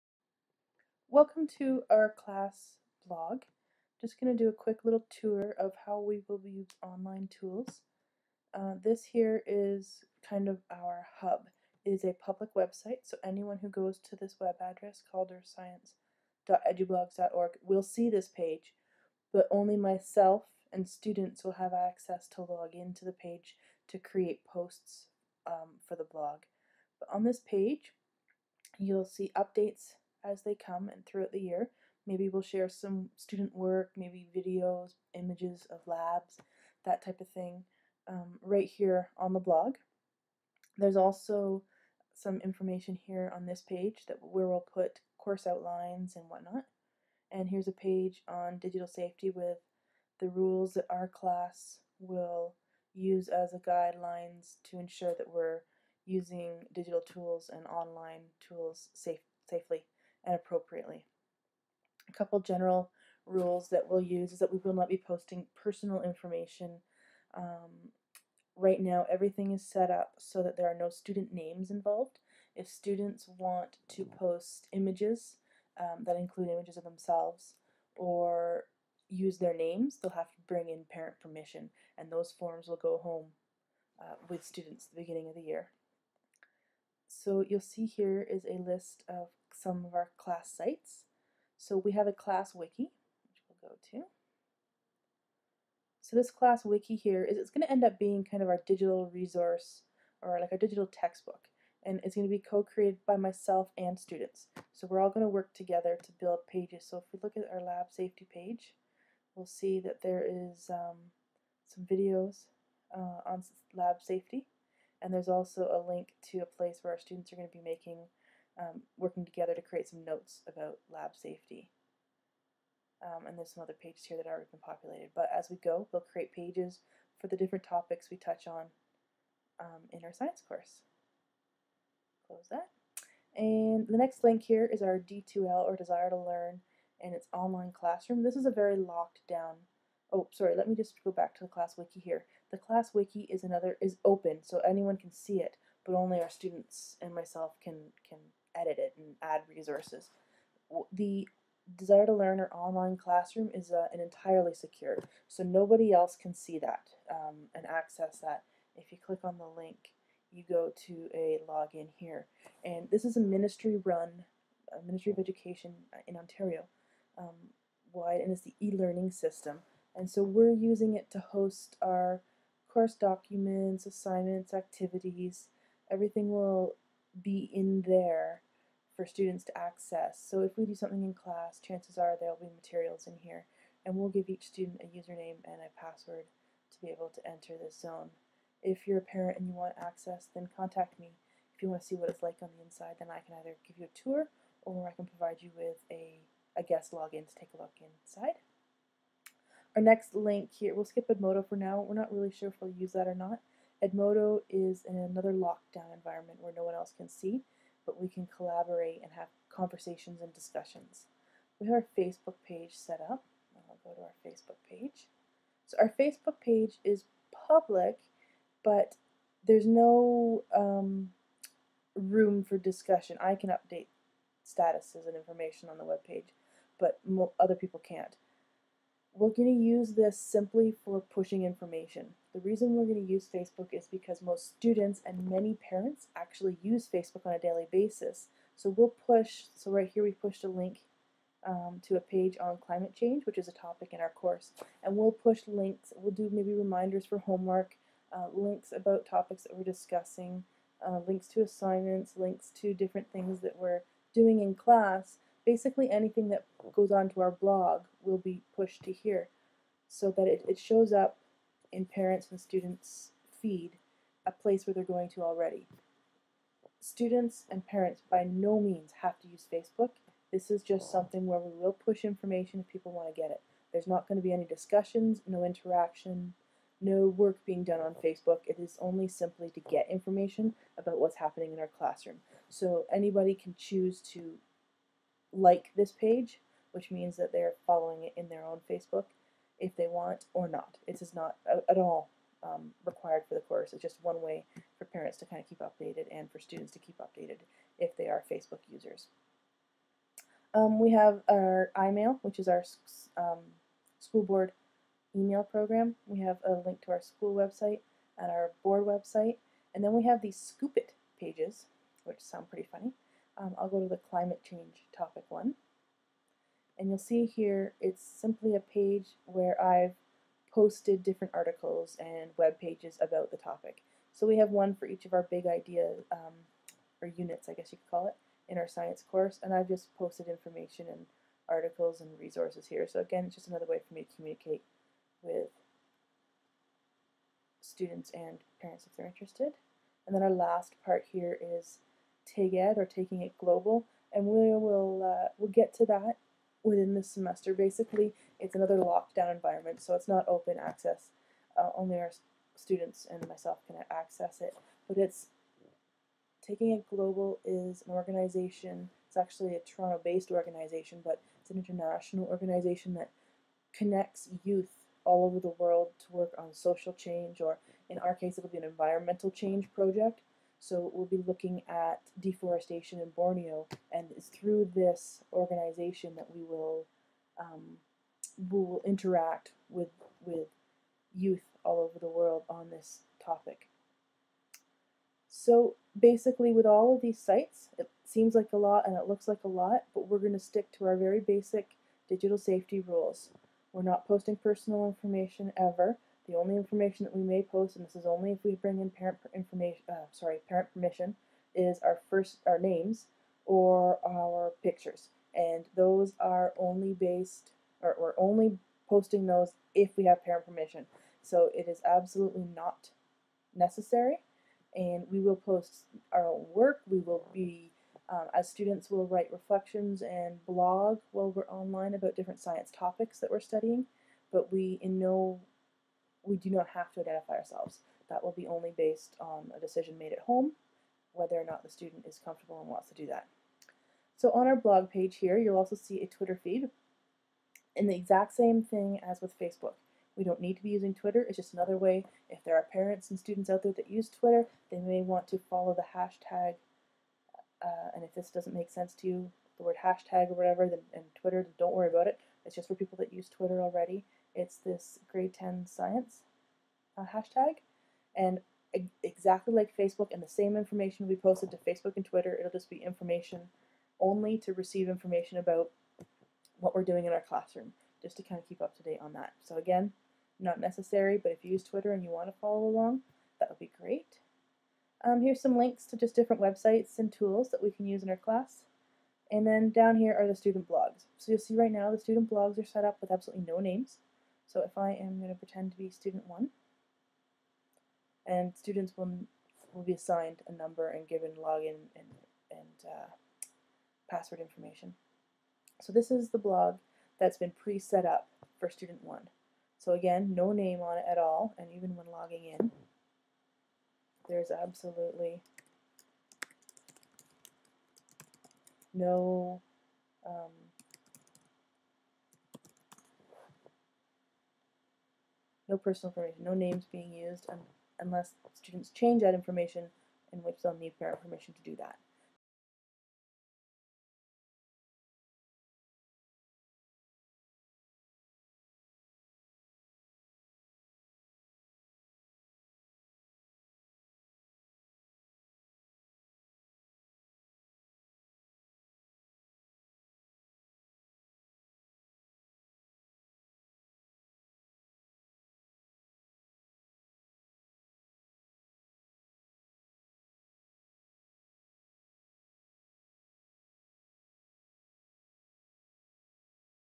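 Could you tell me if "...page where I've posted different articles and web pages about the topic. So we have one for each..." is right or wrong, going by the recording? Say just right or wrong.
right.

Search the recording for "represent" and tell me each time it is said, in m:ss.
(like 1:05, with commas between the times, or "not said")
not said.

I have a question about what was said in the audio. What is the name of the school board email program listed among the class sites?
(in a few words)
iMail.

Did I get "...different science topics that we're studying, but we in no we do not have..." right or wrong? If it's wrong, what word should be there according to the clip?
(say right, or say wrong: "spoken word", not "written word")
right.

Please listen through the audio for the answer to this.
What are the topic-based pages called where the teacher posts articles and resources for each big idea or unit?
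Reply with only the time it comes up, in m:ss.
5:10.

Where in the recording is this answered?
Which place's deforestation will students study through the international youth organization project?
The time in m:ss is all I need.
6:13.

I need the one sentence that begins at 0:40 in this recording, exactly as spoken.
There's also some information here on this page that where we'll put course outlines and whatnot.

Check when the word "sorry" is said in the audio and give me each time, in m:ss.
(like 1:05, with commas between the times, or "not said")
2:20, 6:40.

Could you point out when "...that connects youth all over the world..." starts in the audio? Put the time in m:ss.
6:02.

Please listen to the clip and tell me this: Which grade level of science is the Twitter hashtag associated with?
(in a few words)
grade 10.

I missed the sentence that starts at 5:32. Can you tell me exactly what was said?
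So again, it's just another way for me to communicate with students and parents if they're interested.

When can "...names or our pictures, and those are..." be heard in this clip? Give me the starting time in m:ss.
6:42.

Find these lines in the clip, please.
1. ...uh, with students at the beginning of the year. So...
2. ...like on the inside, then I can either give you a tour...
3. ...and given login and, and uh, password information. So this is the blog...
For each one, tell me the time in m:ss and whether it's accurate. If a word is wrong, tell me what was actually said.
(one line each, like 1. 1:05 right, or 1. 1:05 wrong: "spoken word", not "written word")
1. 1:23 right
2. 3:12 right
3. 8:10 right.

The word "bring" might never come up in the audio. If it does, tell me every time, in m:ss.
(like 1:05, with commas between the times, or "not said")
1:20, 6:38.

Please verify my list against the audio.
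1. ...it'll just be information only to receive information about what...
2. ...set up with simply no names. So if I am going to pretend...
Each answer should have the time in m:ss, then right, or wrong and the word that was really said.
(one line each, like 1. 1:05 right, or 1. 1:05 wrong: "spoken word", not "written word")
1. 7:42 right
2. 8:02 wrong: "absolutely", not "simply".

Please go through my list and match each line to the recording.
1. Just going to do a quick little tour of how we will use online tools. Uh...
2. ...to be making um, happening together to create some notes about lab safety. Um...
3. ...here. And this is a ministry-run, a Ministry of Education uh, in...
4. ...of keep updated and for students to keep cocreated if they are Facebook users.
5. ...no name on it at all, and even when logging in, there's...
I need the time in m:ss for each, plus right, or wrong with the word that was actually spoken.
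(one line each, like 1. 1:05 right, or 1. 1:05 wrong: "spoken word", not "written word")
1. 0:03 right
2. 1:57 wrong: "working", not "happening"
3. 2:41 right
4. 4:55 wrong: "updated", not "cocreated"
5. 8:20 right.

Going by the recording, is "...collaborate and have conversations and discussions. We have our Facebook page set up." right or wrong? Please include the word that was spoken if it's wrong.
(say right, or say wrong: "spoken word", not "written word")
right.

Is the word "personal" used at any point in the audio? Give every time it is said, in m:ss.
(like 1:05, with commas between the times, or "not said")
1:05, 6:34, 8:35.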